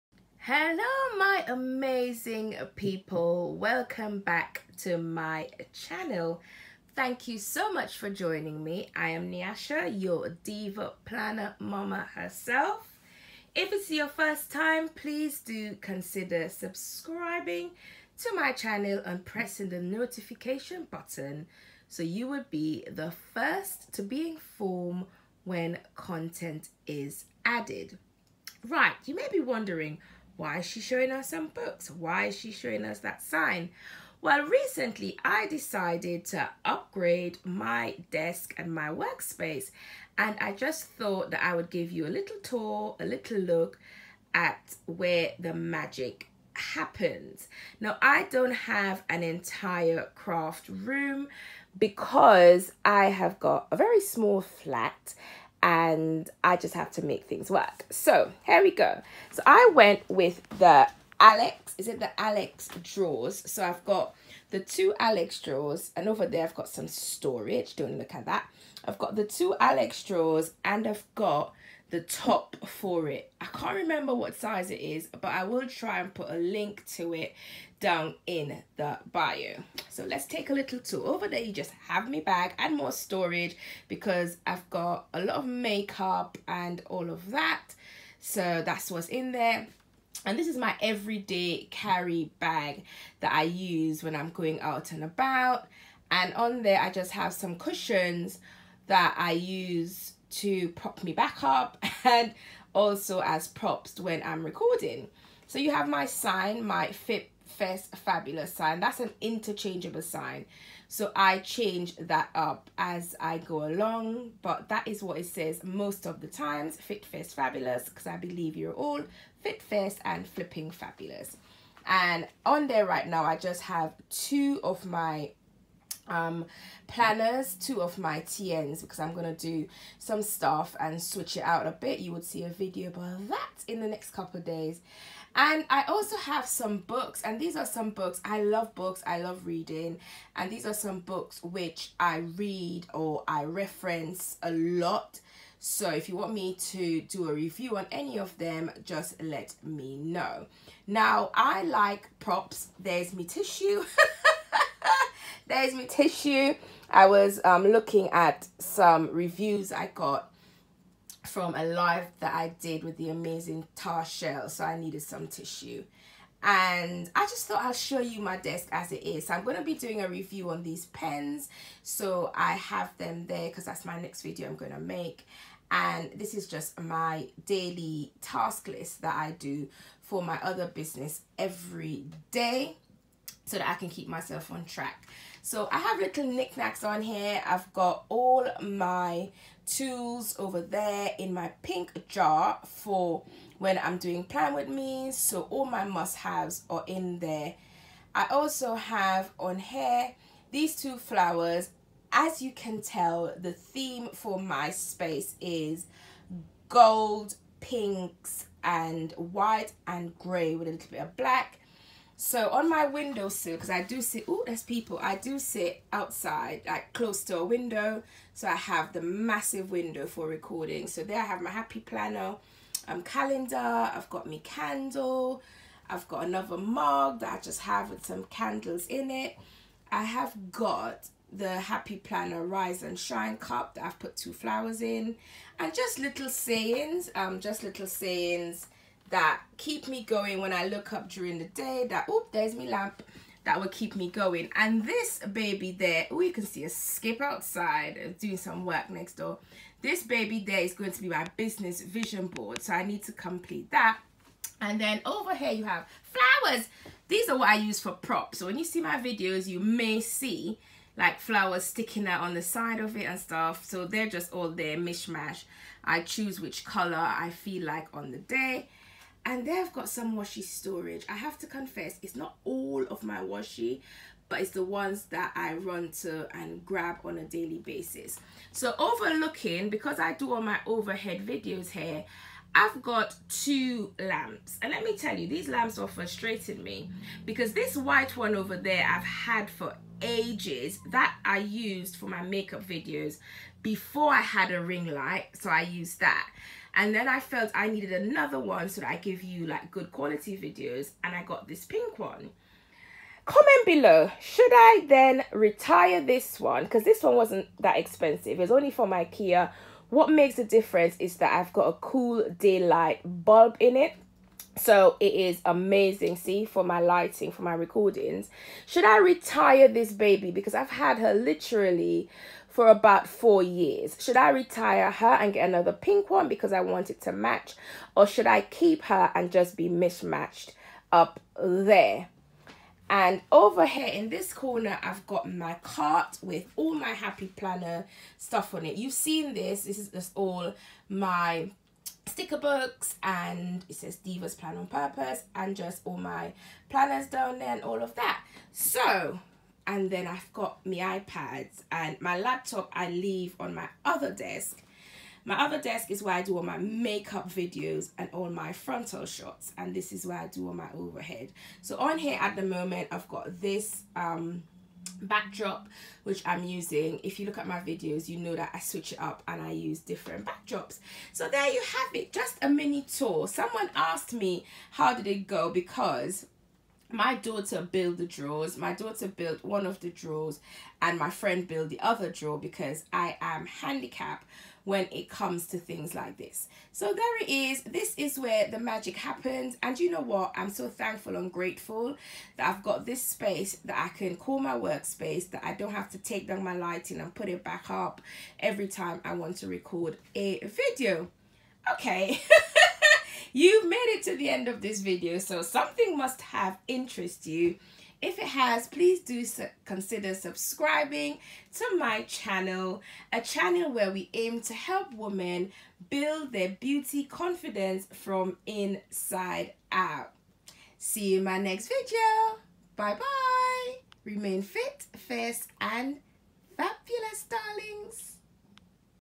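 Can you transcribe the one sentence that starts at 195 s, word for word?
So all my must-haves are in there.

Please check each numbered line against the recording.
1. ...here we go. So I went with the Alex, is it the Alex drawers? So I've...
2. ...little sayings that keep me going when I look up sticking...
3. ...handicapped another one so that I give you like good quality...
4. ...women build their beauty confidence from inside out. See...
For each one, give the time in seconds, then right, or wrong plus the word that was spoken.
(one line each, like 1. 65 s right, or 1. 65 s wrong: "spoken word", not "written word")
1. 58 s right
2. 237 s wrong: "during", not "sticking"
3. 297 s wrong: "needed", not "handicapped"
4. 414 s right.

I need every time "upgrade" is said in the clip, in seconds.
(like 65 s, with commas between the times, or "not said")
36 s.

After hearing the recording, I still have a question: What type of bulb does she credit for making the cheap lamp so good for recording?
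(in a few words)
Cool daylight bulb.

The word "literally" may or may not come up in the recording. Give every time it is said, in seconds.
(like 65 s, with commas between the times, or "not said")
321 s.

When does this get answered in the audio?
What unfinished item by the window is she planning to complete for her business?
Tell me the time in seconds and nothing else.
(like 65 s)
251 s.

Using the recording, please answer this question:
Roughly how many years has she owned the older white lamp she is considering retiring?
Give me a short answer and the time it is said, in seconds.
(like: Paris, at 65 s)
4, at 323 s.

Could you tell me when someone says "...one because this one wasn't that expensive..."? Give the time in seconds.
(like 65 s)
306 s.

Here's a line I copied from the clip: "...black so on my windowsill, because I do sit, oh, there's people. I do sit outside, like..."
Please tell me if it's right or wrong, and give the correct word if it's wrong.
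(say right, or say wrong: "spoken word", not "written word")
right.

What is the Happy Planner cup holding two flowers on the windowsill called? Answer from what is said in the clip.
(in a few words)
Rise and shine.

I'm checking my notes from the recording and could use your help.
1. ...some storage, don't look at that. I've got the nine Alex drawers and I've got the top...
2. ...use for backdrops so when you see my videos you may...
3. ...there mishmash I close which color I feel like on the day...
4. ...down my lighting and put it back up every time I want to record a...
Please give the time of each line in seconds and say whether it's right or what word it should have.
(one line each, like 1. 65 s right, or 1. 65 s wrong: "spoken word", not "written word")
1. 66 s wrong: "two", not "nine"
2. 257 s wrong: "props", not "backdrops"
3. 264 s wrong: "choose", not "close"
4. 396 s right.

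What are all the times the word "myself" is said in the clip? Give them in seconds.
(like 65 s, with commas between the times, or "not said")
184 s.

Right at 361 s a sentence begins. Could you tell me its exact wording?
So on here at the moment I've got this um, backdrop which I'm using.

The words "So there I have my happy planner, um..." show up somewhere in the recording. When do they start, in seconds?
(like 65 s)
220 s.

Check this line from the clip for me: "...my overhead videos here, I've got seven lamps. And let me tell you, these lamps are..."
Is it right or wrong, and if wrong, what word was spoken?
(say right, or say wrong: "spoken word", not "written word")
wrong: "two", not "seven".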